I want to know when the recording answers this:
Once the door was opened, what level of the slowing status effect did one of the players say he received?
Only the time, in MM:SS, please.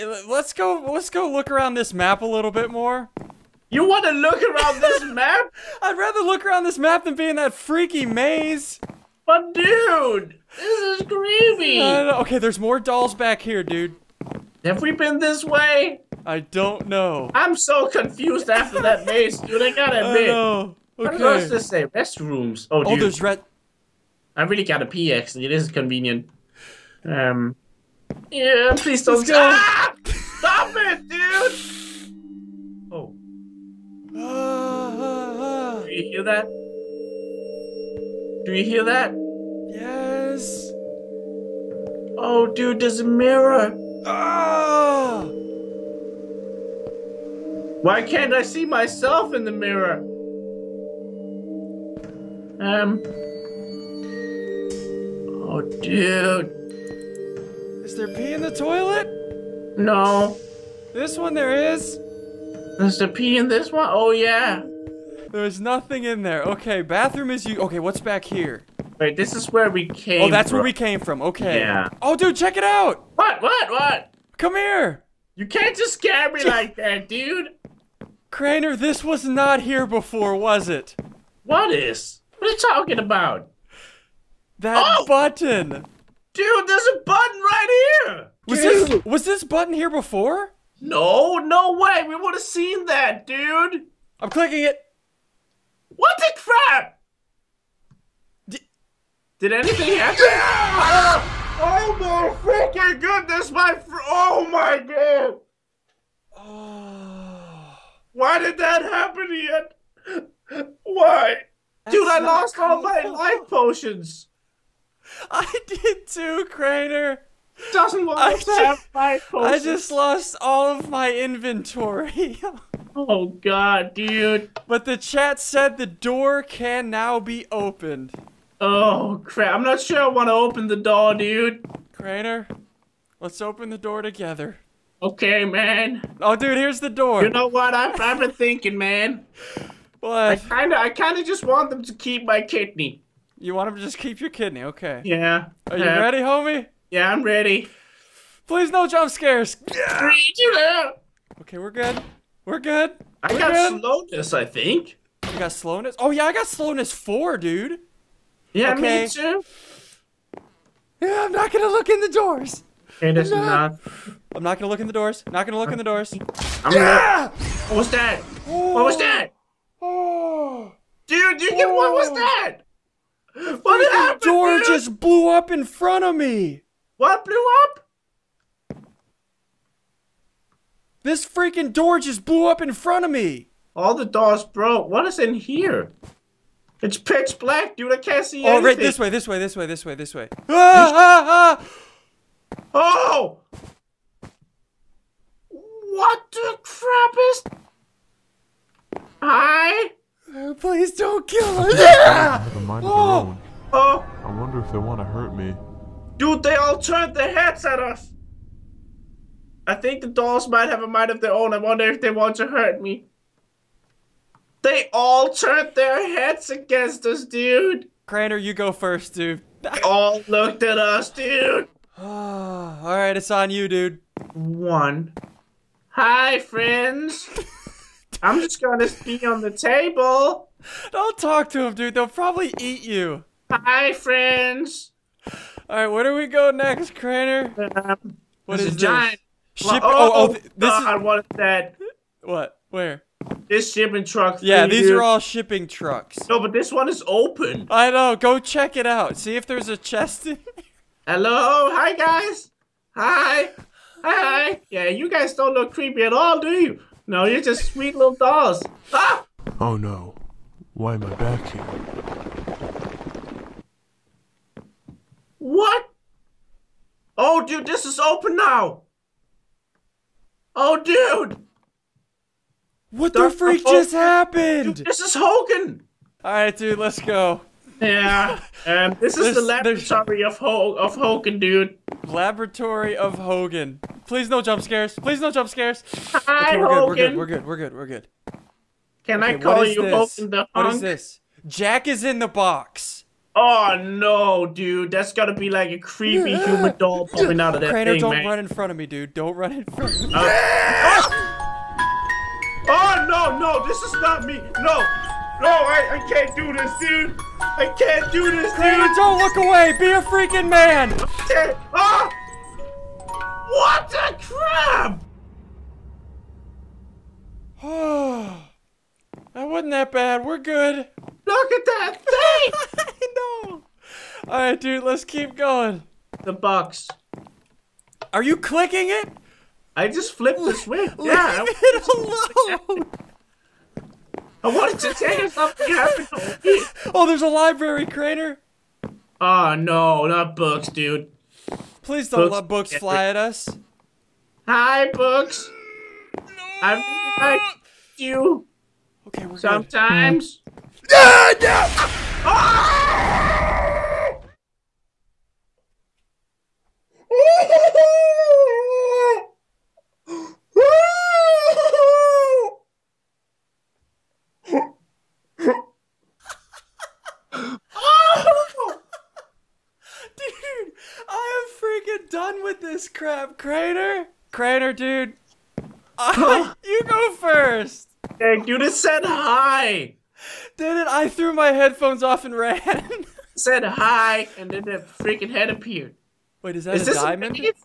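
02:36.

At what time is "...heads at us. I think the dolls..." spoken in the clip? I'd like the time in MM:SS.
03:27.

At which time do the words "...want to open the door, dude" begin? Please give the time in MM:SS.
02:10.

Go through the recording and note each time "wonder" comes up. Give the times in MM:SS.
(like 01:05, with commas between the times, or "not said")
03:24, 03:31.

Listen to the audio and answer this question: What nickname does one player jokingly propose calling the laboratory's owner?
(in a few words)
Hogan the Hunk.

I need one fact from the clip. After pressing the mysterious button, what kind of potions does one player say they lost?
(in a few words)
Life potions.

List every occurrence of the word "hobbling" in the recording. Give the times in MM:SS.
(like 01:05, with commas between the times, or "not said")
not said.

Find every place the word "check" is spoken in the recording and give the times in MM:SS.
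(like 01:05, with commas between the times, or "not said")
01:12, 04:08.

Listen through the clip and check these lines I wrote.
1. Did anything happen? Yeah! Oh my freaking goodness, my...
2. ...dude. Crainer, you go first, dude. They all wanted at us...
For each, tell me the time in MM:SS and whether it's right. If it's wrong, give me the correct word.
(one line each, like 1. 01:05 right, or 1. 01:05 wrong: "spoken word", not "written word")
1. 01:39 right
2. 03:37 wrong: "looked", not "wanted".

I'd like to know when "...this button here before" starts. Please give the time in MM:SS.
01:29.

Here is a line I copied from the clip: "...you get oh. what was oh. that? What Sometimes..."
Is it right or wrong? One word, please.
wrong.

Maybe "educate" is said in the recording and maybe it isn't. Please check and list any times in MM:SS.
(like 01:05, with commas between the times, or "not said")
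not said.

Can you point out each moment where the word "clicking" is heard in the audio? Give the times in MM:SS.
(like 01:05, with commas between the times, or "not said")
01:34, 05:28.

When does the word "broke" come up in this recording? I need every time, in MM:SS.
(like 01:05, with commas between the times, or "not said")
03:04.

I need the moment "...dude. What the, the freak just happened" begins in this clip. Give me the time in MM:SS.
04:30.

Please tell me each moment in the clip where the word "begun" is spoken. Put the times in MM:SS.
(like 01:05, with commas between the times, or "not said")
not said.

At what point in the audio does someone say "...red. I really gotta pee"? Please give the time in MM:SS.
00:23.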